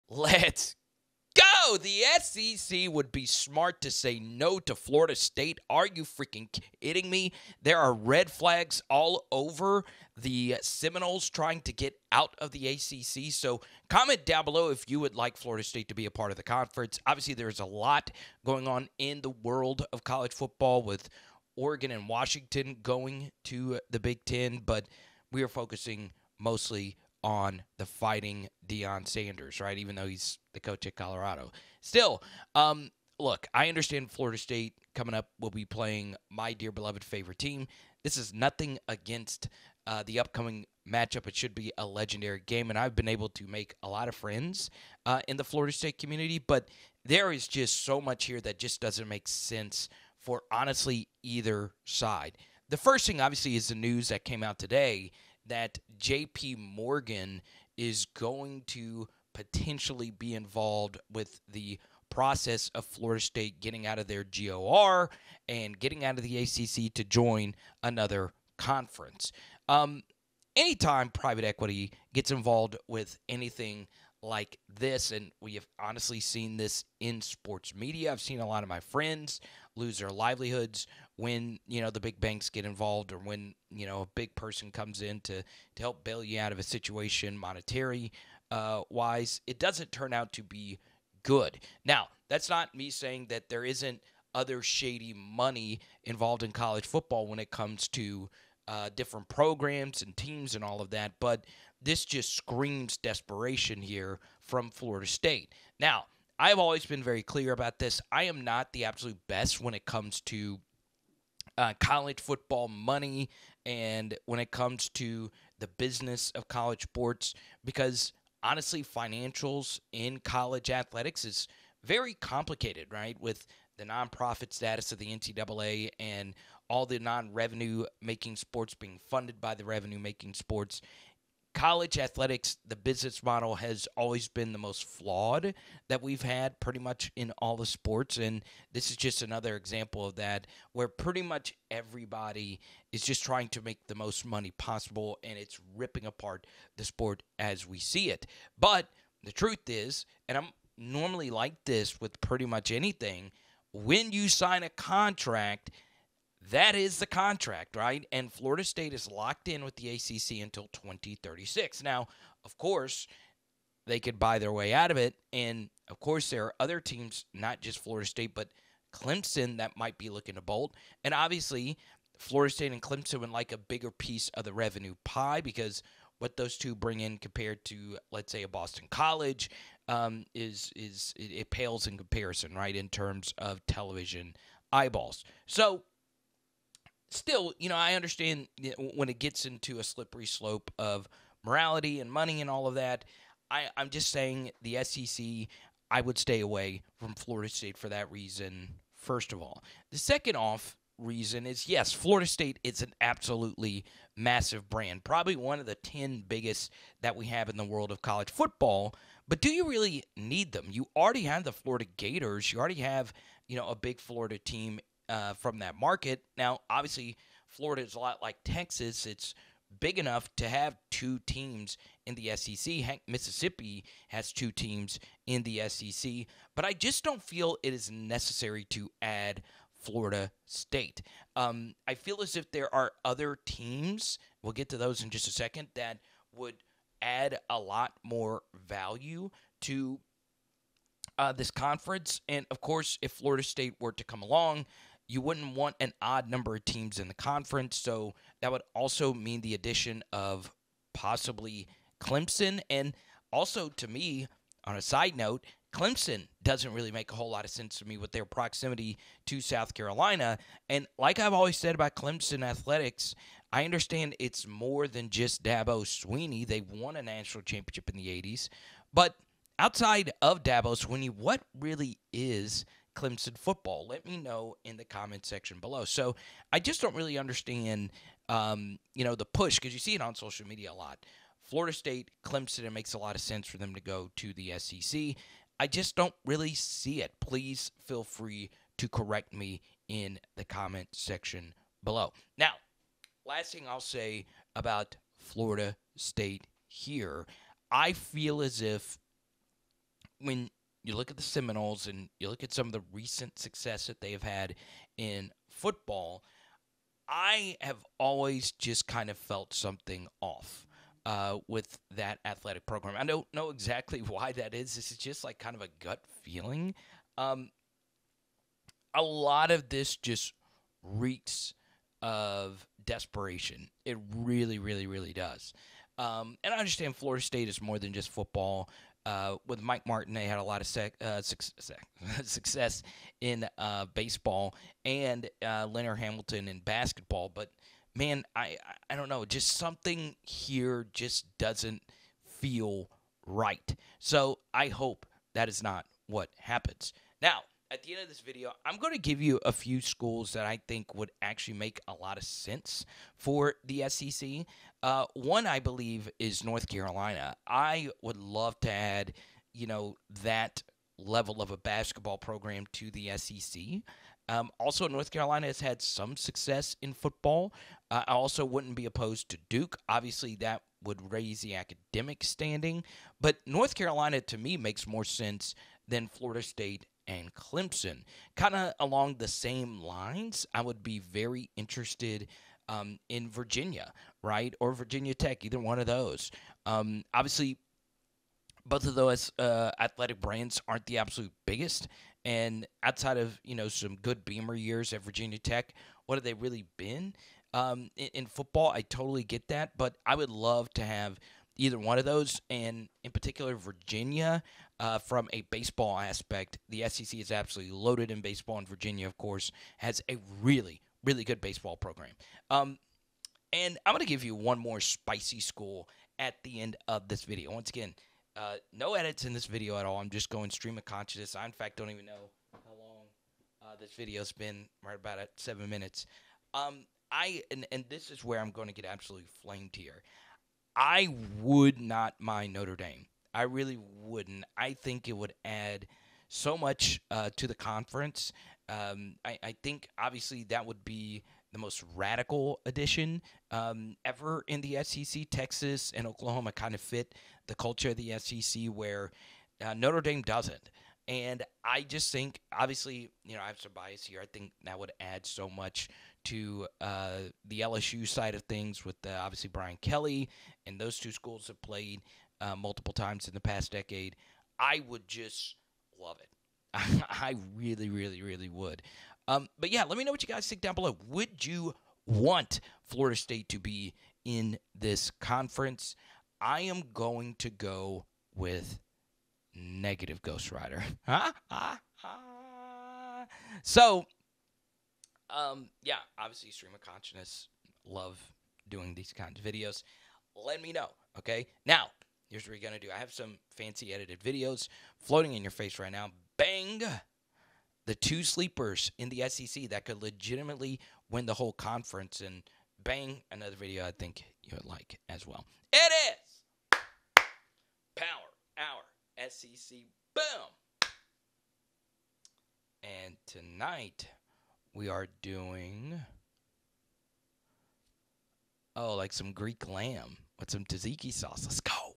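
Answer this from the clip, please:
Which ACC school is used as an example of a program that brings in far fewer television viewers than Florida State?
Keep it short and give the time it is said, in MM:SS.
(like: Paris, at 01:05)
Boston College, at 02:58.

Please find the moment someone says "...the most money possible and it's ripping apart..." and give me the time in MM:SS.
02:23.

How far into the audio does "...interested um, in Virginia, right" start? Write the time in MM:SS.
06:21.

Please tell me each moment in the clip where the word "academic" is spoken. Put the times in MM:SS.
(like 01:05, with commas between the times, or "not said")
06:11.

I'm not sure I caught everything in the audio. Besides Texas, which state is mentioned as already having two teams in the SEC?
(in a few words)
Mississippi.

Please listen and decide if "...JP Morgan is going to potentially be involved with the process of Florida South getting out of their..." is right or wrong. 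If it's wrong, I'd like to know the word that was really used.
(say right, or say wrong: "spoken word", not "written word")
wrong: "State", not "South".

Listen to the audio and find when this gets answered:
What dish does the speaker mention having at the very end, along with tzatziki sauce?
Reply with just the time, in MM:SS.
08:39.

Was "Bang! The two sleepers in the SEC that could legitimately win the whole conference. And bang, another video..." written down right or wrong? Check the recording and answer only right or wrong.
right.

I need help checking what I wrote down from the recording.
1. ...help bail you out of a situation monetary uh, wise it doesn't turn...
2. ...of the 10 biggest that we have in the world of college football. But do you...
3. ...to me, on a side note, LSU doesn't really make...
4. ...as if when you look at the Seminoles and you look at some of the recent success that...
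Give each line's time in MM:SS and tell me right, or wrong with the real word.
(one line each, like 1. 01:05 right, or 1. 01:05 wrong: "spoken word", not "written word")
1. 01:25 right
2. 03:25 right
3. 04:13 wrong: "Clemson", not "LSU"
4. 04:58 right.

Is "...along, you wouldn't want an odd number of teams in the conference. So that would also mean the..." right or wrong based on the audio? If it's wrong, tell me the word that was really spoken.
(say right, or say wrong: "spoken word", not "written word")
right.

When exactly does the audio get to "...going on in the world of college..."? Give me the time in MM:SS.
00:18.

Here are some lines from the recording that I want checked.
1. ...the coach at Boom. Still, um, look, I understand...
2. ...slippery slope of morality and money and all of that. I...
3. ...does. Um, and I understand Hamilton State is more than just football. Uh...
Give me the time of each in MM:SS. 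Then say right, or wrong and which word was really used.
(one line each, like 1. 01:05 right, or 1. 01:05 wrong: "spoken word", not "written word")
1. 00:30 wrong: "Colorado", not "Boom"
2. 03:09 right
3. 05:25 wrong: "Florida", not "Hamilton".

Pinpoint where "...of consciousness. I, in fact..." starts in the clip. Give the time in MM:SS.
07:00.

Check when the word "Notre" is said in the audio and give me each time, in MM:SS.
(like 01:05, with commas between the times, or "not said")
07:12, 07:29.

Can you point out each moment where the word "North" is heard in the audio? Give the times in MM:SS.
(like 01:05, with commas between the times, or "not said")
05:56, 06:04, 06:13.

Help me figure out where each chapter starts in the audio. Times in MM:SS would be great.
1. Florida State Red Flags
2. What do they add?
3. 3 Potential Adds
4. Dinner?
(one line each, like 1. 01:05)
1. 00:11
2. 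03:45
3. 05:45
4. 08:25.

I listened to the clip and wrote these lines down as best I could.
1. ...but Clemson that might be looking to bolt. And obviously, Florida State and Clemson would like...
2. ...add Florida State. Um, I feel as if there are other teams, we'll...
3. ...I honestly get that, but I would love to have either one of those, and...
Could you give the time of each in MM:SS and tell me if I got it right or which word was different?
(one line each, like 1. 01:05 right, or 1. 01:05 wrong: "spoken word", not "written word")
1. 02:48 right
2. 03:49 right
3. 06:38 wrong: "totally", not "honestly".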